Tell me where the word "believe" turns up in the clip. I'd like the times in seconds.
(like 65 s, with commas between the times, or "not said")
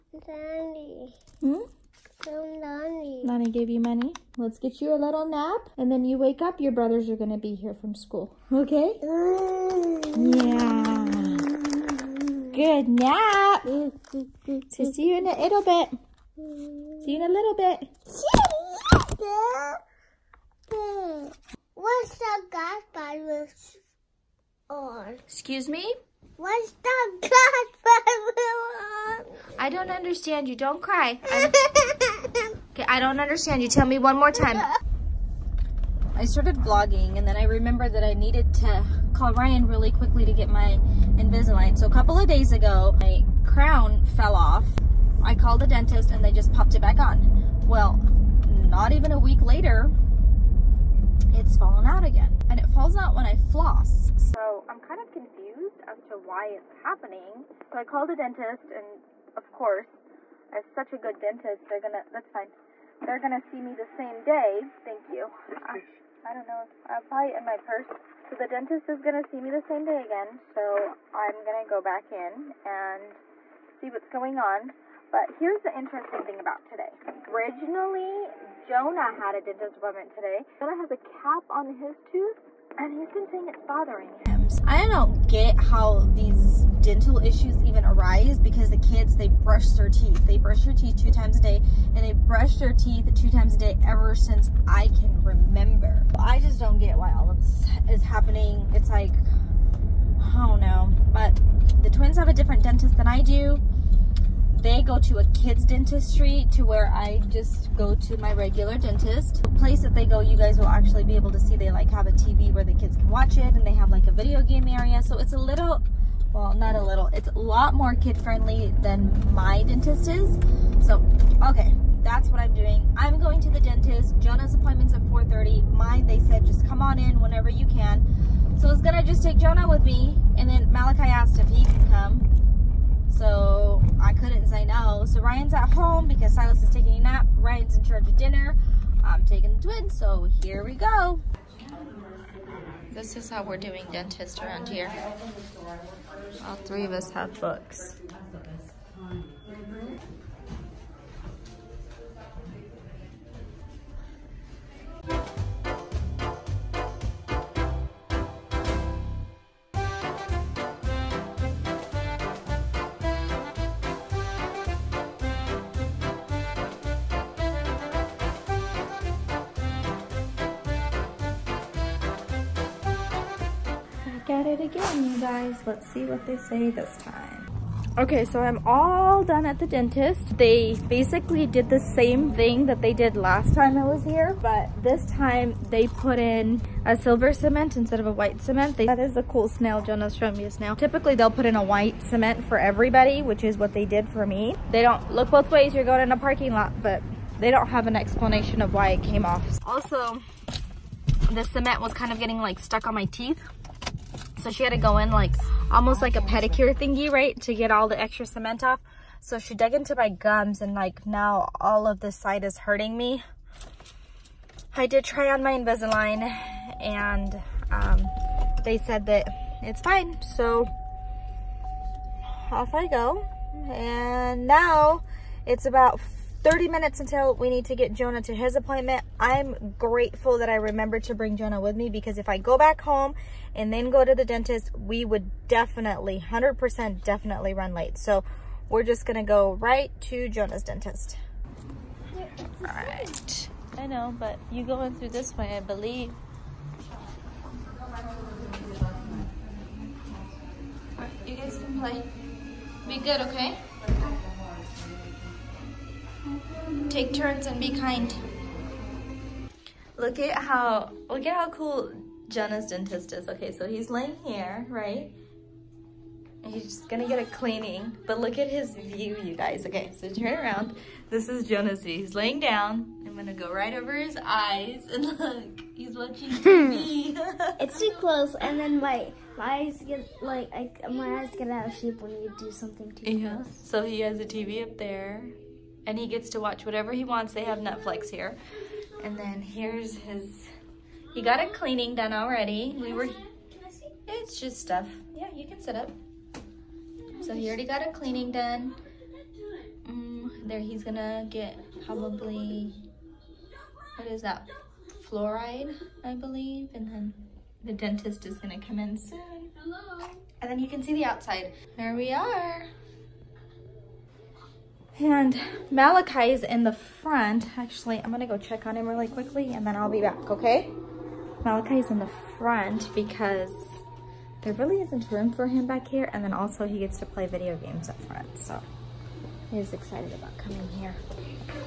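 245 s, 306 s.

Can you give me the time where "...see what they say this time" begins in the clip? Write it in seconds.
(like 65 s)
175 s.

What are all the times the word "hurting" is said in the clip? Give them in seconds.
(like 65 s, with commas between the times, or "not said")
212 s.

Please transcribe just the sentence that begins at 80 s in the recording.
Jonah has a cap on his tooth and he's been saying it's bothering him.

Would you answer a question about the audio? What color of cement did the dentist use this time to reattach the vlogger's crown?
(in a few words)
Silver.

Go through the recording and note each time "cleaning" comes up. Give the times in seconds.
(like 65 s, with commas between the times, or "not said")
267 s, 291 s, 297 s.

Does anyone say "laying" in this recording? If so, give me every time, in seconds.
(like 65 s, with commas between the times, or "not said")
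263 s, 272 s.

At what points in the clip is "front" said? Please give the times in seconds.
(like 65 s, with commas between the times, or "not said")
316 s, 322 s, 328 s.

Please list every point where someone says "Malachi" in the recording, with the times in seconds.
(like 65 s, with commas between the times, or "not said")
130 s, 315 s, 321 s.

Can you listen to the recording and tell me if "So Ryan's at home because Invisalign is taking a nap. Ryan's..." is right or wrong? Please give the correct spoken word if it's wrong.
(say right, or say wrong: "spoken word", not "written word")
wrong: "Silas", not "Invisalign".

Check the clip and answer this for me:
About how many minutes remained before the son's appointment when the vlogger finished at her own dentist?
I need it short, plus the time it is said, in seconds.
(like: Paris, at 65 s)
30, at 226 s.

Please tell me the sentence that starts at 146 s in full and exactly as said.
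All three of us have books.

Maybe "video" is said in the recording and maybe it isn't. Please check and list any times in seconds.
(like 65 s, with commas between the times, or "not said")
114 s, 327 s.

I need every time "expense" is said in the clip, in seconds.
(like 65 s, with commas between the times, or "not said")
not said.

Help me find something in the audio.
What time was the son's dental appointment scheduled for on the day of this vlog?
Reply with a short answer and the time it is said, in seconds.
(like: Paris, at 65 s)
4:30, at 125 s.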